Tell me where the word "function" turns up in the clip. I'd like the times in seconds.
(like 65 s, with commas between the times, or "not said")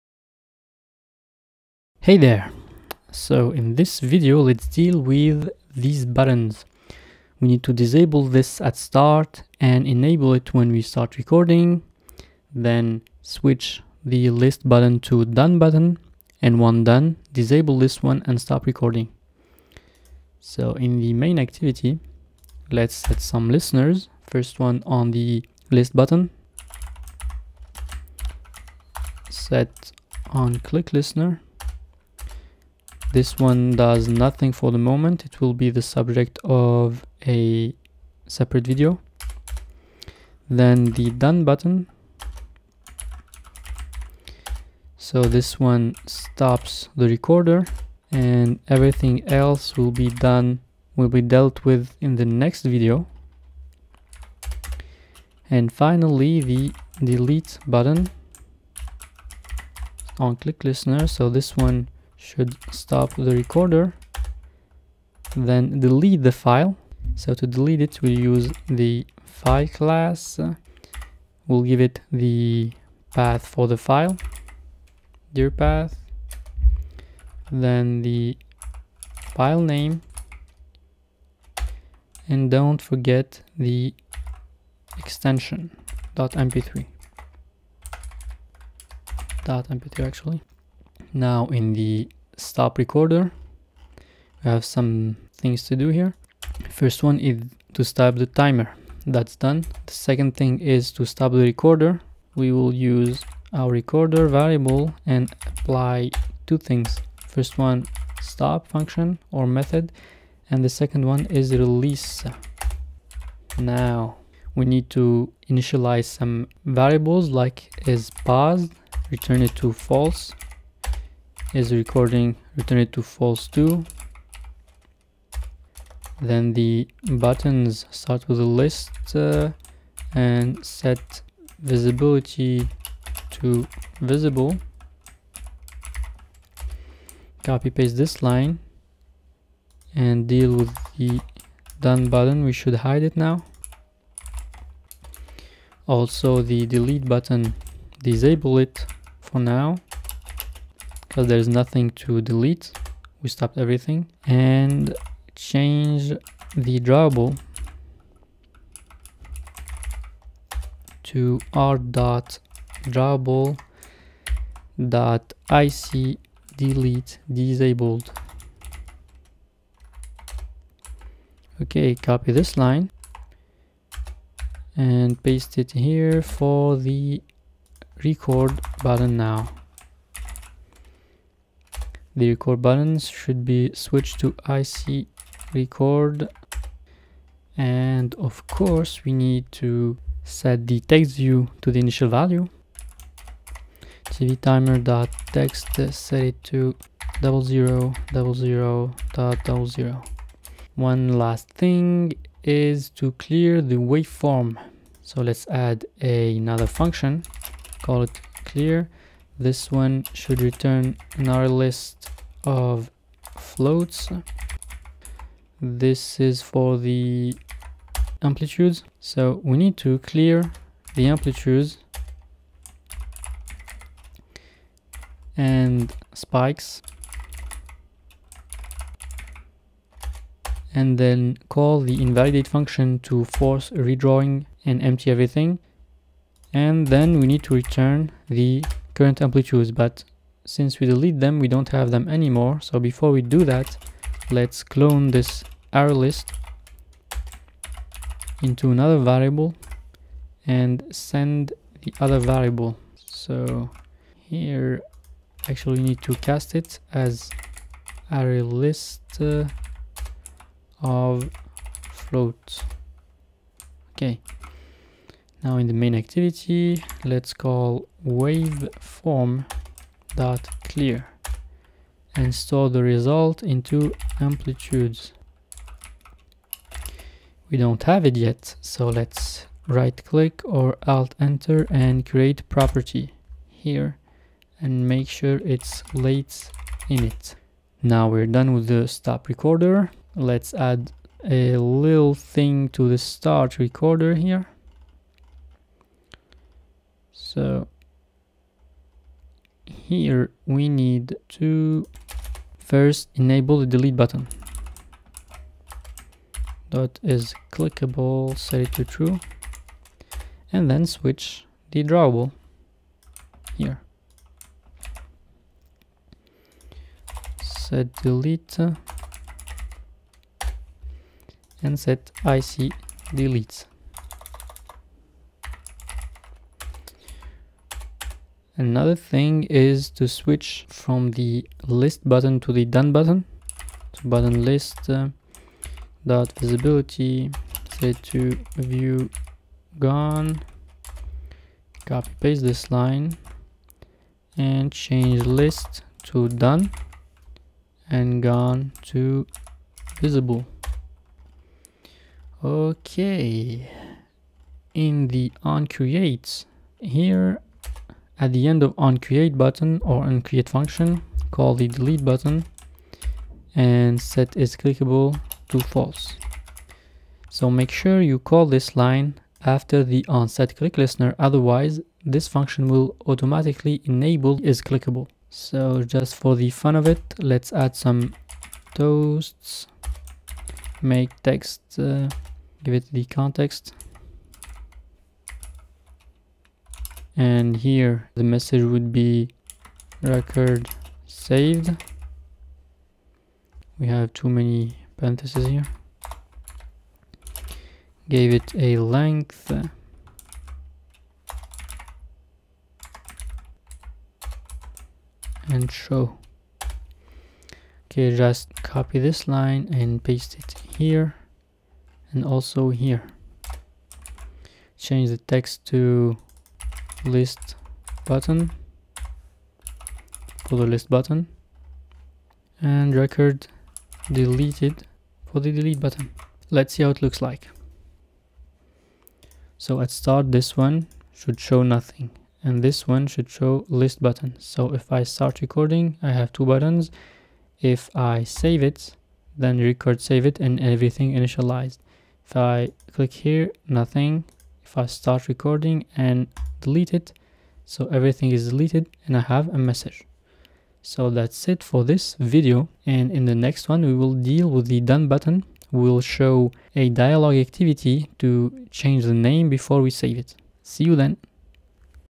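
108 s, 206 s, 232 s, 360 s, 372 s.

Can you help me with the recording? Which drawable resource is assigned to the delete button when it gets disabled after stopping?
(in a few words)
ic delete disabled.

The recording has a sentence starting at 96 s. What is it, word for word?
First one is to stop the timer.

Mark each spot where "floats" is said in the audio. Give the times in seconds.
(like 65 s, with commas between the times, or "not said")
213 s, 261 s.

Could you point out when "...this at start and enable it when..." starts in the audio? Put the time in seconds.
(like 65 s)
8 s.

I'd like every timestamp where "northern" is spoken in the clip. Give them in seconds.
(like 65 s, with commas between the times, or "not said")
not said.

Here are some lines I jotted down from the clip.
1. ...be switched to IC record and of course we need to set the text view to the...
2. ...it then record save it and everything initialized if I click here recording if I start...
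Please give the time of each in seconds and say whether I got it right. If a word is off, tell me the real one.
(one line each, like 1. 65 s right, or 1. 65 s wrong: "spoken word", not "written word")
1. 183 s right
2. 438 s wrong: "nothing", not "recording".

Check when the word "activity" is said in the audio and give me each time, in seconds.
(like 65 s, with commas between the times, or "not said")
21 s, 265 s, 457 s.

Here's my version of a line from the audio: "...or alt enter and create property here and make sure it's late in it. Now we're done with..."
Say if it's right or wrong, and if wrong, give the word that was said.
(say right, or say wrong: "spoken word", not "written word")
right.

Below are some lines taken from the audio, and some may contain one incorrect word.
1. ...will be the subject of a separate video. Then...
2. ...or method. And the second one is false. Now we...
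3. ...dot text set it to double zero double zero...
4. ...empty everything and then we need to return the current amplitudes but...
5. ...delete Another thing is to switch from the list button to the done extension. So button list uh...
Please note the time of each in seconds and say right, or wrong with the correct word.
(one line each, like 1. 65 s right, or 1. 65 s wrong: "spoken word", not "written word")
1. 35 s right
2. 109 s wrong: "release", not "false"
3. 194 s right
4. 234 s right
5. 323 s wrong: "button", not "extension".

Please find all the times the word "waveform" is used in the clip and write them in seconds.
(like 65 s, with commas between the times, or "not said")
203 s, 268 s.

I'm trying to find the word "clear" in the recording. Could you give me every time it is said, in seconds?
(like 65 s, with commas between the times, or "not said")
203 s, 208 s, 219 s, 270 s.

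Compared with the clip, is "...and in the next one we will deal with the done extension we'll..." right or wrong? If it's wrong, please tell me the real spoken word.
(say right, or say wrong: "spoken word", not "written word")
wrong: "button", not "extension".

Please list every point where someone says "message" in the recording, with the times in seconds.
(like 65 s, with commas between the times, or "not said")
388 s, 449 s.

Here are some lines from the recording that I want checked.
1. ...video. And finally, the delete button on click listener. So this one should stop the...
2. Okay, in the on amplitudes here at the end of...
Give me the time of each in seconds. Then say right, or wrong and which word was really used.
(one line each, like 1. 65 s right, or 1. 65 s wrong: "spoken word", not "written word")
1. 52 s right
2. 352 s wrong: "creates", not "amplitudes".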